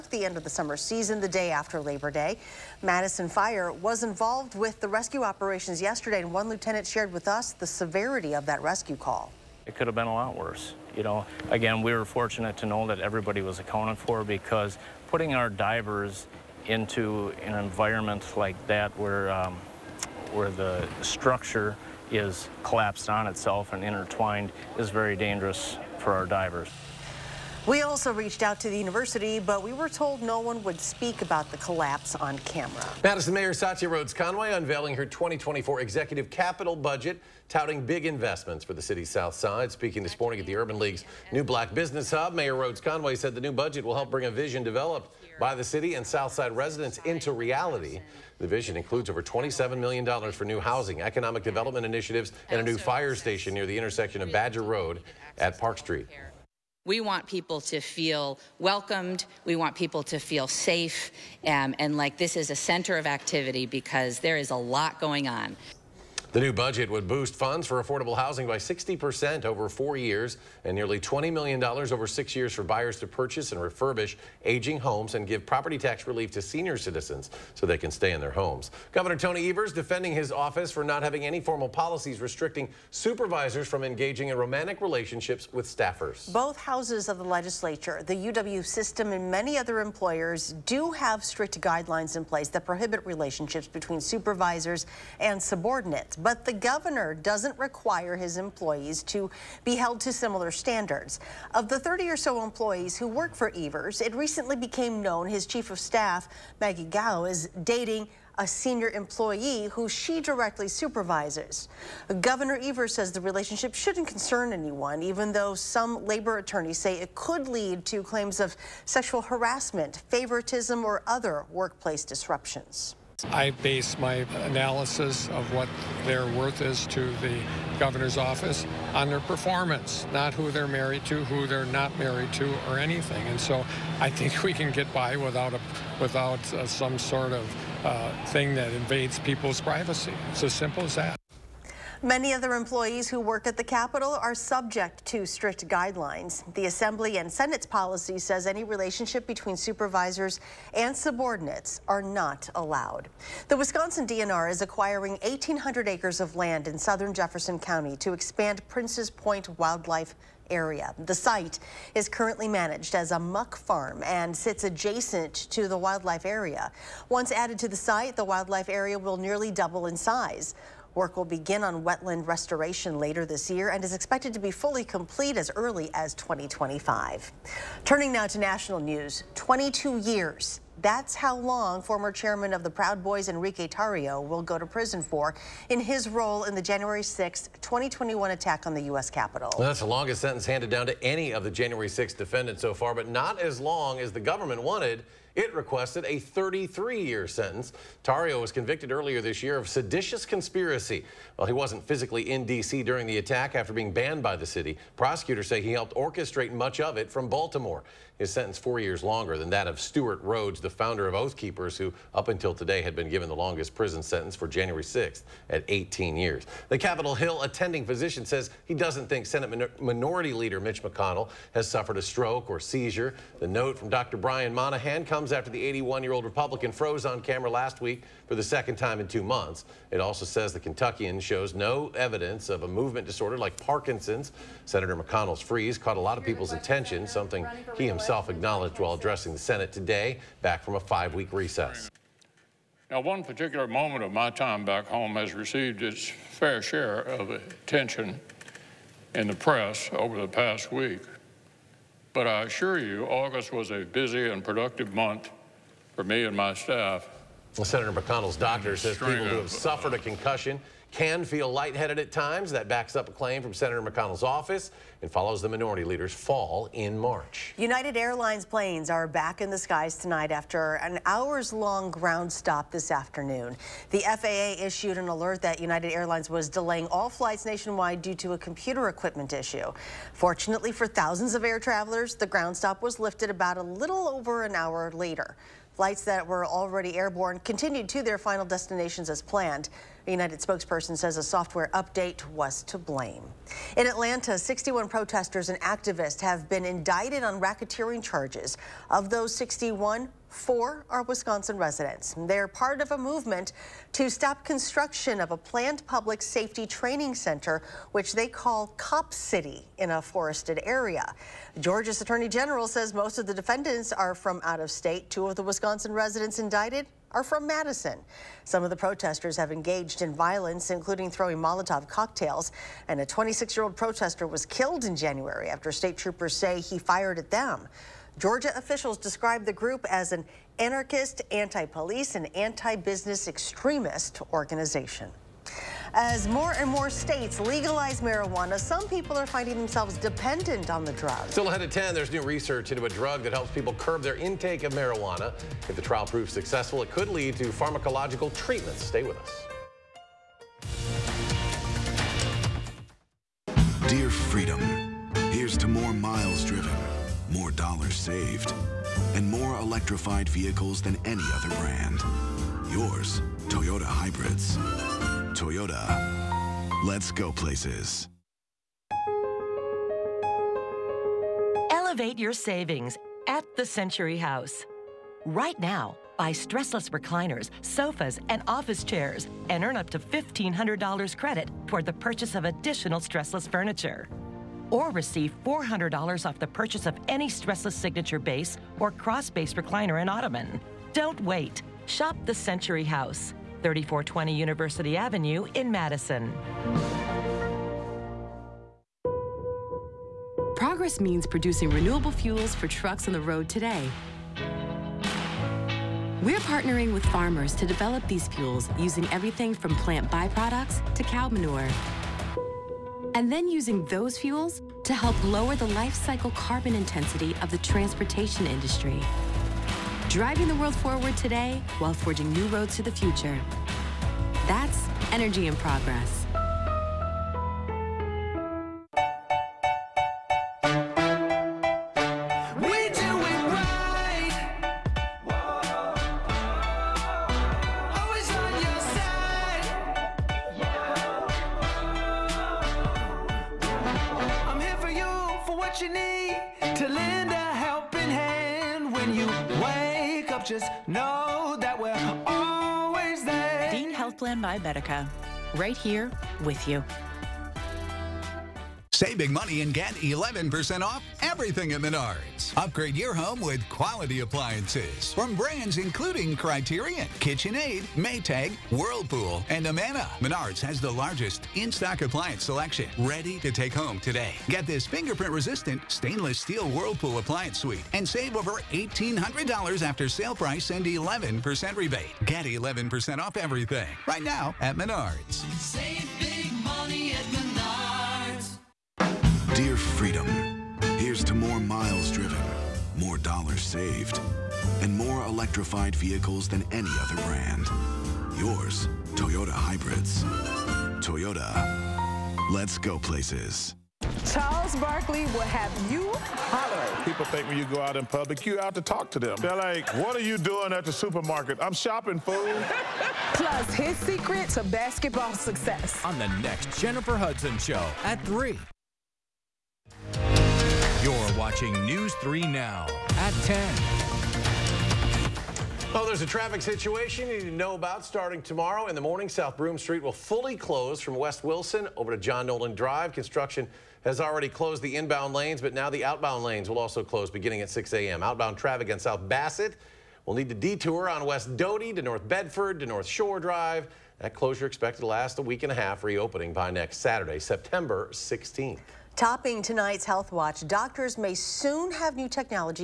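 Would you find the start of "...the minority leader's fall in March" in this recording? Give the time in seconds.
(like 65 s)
265 s.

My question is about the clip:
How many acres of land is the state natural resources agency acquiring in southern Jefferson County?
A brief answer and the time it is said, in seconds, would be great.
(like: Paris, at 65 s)
1,800, at 155 s.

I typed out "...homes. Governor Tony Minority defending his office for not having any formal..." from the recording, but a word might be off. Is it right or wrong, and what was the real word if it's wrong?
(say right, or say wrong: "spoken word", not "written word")
wrong: "Evers", not "Minority".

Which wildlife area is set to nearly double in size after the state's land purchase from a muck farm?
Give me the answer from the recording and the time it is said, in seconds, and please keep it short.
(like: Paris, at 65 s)
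Prince's Point, at 158 s.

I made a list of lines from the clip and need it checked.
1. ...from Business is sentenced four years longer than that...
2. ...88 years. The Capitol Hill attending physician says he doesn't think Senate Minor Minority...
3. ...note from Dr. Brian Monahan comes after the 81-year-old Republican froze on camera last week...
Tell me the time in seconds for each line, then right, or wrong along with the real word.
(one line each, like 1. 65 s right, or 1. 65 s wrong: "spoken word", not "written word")
1. 207 s wrong: "Baltimore", not "Business"
2. 215 s wrong: "18", not "88"
3. 223 s right.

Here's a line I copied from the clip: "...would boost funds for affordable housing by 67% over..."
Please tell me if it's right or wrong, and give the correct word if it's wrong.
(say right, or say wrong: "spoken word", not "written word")
wrong: "60", not "67".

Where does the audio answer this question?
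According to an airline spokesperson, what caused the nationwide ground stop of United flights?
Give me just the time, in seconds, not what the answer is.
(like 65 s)
291 s.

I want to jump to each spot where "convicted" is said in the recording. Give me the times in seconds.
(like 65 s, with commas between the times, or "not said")
198 s.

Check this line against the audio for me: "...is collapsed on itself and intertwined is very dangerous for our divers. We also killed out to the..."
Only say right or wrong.
wrong.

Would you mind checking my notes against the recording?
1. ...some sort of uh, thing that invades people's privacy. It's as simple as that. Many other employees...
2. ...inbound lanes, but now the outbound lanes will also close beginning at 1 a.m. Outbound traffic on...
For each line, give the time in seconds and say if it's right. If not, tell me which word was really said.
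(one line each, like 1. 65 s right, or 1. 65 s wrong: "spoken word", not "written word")
1. 136 s right
2. 534 s wrong: "6", not "1".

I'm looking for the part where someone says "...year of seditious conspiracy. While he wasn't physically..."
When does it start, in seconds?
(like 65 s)
199 s.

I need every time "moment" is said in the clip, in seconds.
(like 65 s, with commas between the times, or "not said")
243 s.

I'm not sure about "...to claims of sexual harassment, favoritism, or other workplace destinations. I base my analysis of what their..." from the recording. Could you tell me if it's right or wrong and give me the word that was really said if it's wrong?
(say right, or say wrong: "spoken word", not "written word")
wrong: "disruptions", not "destinations".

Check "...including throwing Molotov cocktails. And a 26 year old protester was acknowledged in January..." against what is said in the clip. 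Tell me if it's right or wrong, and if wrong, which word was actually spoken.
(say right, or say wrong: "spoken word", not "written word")
wrong: "killed", not "acknowledged".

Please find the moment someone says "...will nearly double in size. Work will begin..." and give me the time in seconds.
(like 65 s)
168 s.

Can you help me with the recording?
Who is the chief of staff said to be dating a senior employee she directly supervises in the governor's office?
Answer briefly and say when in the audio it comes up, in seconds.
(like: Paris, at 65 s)
Maggie Gau, at 106 s.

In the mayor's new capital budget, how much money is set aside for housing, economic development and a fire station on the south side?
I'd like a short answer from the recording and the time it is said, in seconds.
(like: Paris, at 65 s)
over $27 million, at 49 s.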